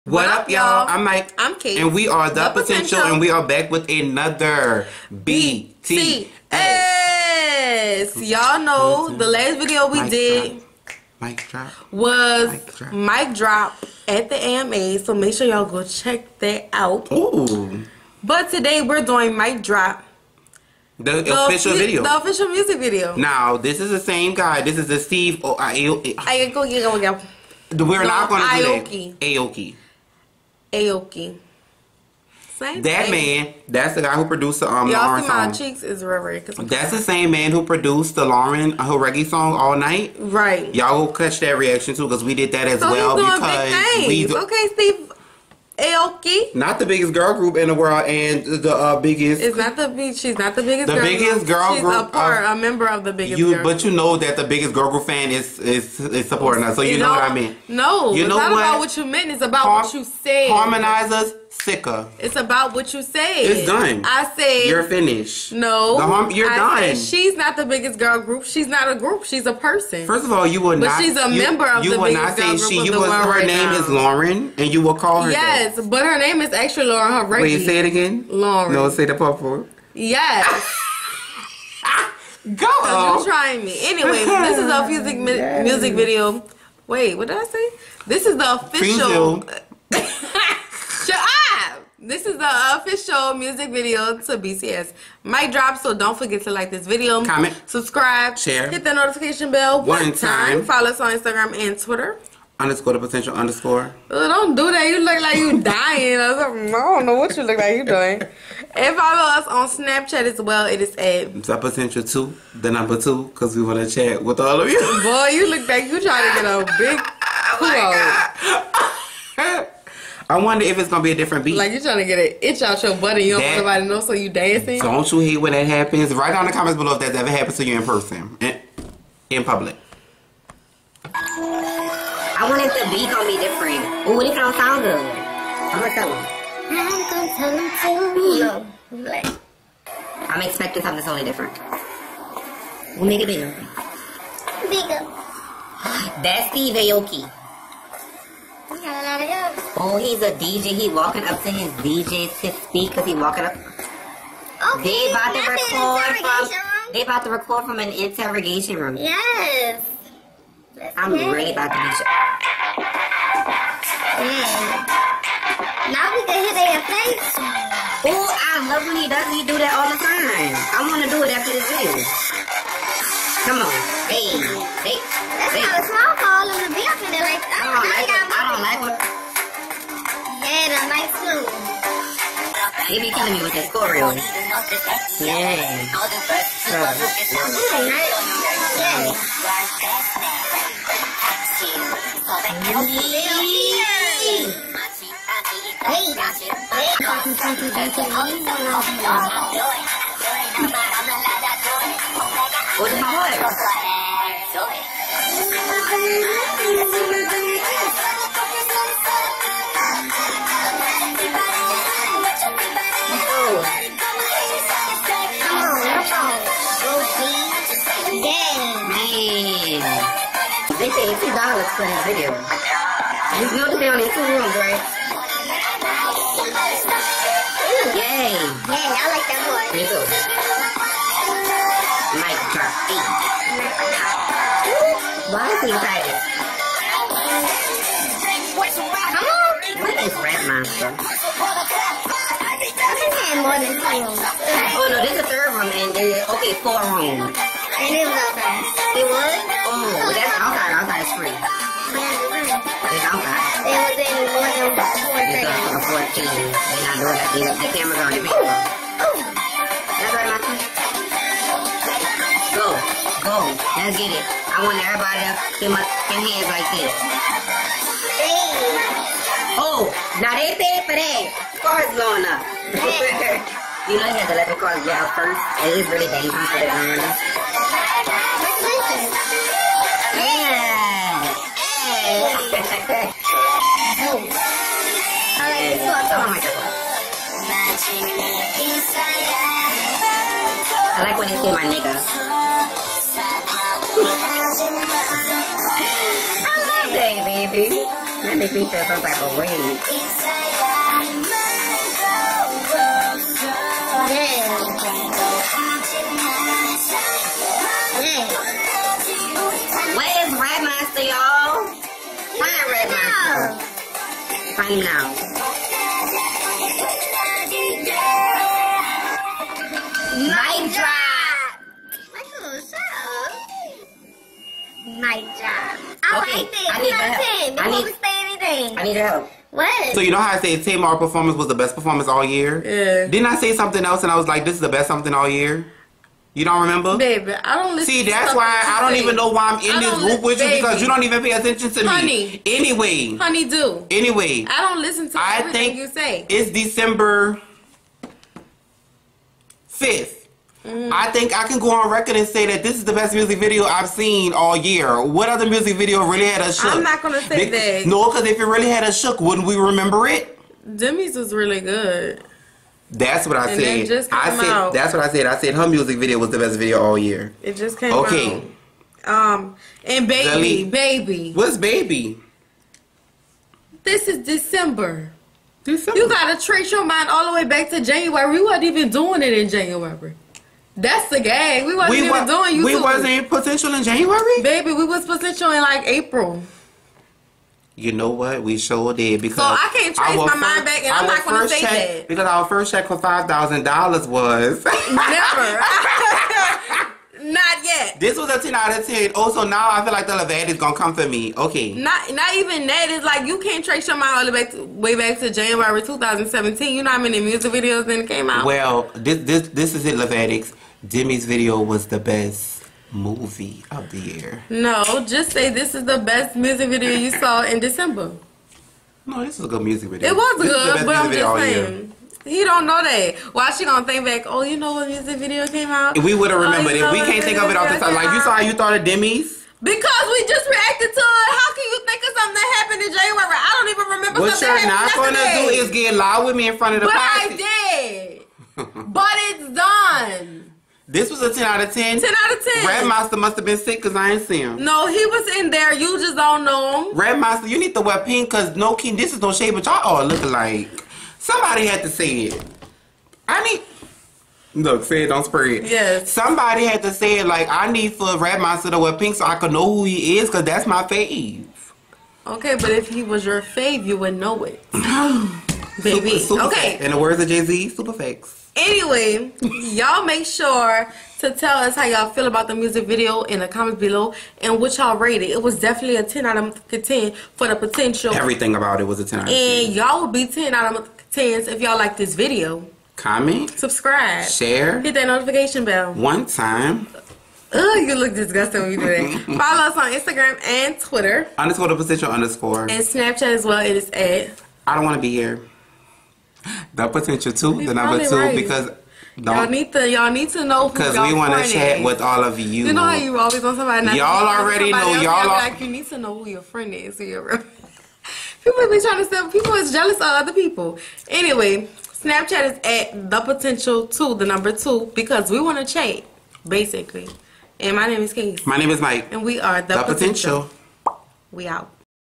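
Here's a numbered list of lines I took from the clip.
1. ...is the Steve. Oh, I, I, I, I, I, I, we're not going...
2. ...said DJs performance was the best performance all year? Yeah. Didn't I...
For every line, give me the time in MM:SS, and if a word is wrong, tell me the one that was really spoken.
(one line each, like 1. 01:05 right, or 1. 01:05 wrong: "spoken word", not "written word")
1. 00:24 right
2. 05:30 wrong: "Tamar", not "DJs".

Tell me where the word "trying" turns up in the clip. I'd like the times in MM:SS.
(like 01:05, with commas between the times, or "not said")
01:23, 01:56, 02:01, 08:28.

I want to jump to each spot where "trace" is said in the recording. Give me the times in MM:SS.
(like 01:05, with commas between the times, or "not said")
06:16, 06:29, 06:43.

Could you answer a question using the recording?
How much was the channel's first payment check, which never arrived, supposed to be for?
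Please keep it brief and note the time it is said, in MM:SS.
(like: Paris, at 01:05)
$5,000, at 06:32.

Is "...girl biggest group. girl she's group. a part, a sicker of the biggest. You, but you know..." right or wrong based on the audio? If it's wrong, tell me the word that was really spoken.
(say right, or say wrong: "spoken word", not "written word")
wrong: "member", not "sicker".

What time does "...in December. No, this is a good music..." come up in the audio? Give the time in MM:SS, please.
06:57.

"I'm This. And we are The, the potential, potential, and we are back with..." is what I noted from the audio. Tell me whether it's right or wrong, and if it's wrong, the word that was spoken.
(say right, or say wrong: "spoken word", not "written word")
wrong: "Kate", not "This".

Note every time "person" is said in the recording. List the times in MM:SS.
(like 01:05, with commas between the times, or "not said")
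01:09, 02:07.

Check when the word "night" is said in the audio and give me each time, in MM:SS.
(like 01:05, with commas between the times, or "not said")
00:39, 05:20.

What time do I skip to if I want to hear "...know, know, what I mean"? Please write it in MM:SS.
00:56.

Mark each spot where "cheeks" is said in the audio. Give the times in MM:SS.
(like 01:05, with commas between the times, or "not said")
00:35.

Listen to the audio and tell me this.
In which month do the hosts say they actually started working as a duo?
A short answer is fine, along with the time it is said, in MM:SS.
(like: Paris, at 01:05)
April, at 06:25.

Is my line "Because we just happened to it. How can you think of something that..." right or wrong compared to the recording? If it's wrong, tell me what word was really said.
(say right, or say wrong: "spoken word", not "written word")
wrong: "reacted", not "happened".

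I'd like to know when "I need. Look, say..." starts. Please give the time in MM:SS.
07:33.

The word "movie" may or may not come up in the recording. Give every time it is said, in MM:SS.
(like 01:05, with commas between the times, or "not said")
06:52.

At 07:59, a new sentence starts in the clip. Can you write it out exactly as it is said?
And y'all would be 10 out of Tens, if y'all like this video, comment, subscribe, share, hit that notification bell.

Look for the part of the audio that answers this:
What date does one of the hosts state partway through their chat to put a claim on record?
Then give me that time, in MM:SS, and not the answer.
05:46.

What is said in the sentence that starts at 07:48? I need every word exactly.
Anyway, y'all make sure to tell us how y'all feel about the music video in the comments below and what y'all rated.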